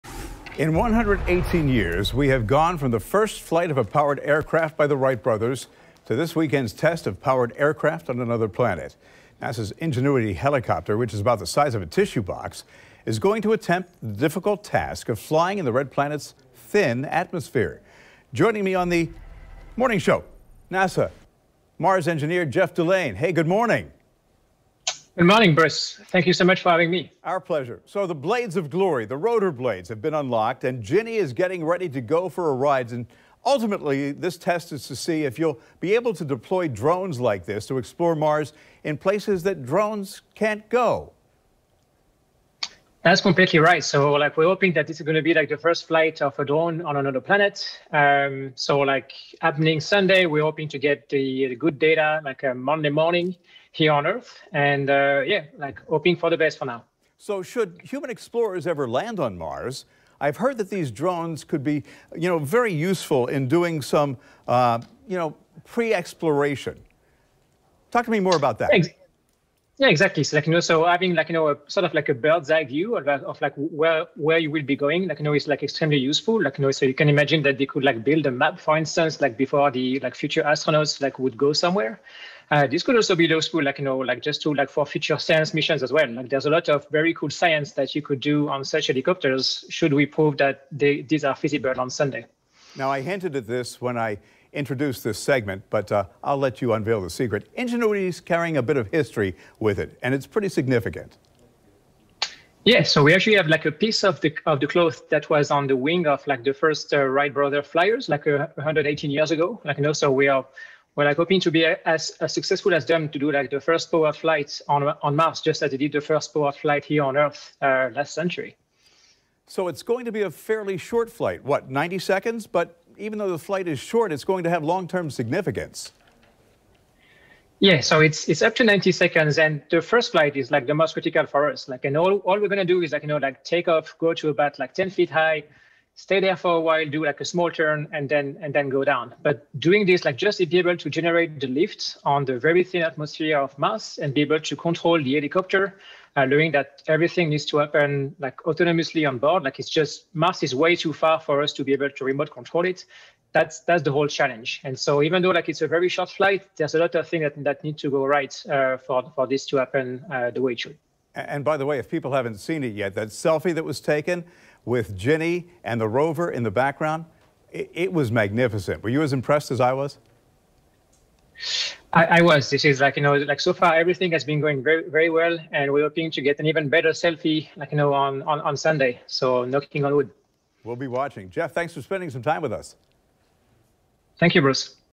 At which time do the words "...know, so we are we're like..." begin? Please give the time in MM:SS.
01:49.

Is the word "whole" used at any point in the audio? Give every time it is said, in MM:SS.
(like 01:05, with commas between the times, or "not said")
02:33.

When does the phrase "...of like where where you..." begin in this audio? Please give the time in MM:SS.
01:13.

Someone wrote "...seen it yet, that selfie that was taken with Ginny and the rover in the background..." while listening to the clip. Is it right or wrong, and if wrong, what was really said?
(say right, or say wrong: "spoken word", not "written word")
right.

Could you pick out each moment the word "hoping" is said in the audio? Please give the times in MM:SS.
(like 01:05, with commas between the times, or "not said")
00:44, 00:50, 00:55, 01:51, 02:55.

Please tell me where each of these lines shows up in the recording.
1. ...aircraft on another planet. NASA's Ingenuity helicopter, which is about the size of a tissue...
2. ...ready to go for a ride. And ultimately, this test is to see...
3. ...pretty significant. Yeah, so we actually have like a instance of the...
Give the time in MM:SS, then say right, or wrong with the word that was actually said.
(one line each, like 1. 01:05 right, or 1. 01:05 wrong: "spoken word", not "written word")
1. 00:07 right
2. 00:31 right
3. 01:40 wrong: "piece", not "instance".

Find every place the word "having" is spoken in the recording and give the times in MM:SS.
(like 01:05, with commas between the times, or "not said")
00:26, 01:10.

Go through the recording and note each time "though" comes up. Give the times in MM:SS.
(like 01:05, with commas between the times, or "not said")
02:03, 02:35.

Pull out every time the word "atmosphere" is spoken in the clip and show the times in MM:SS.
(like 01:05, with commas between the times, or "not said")
00:17, 02:22.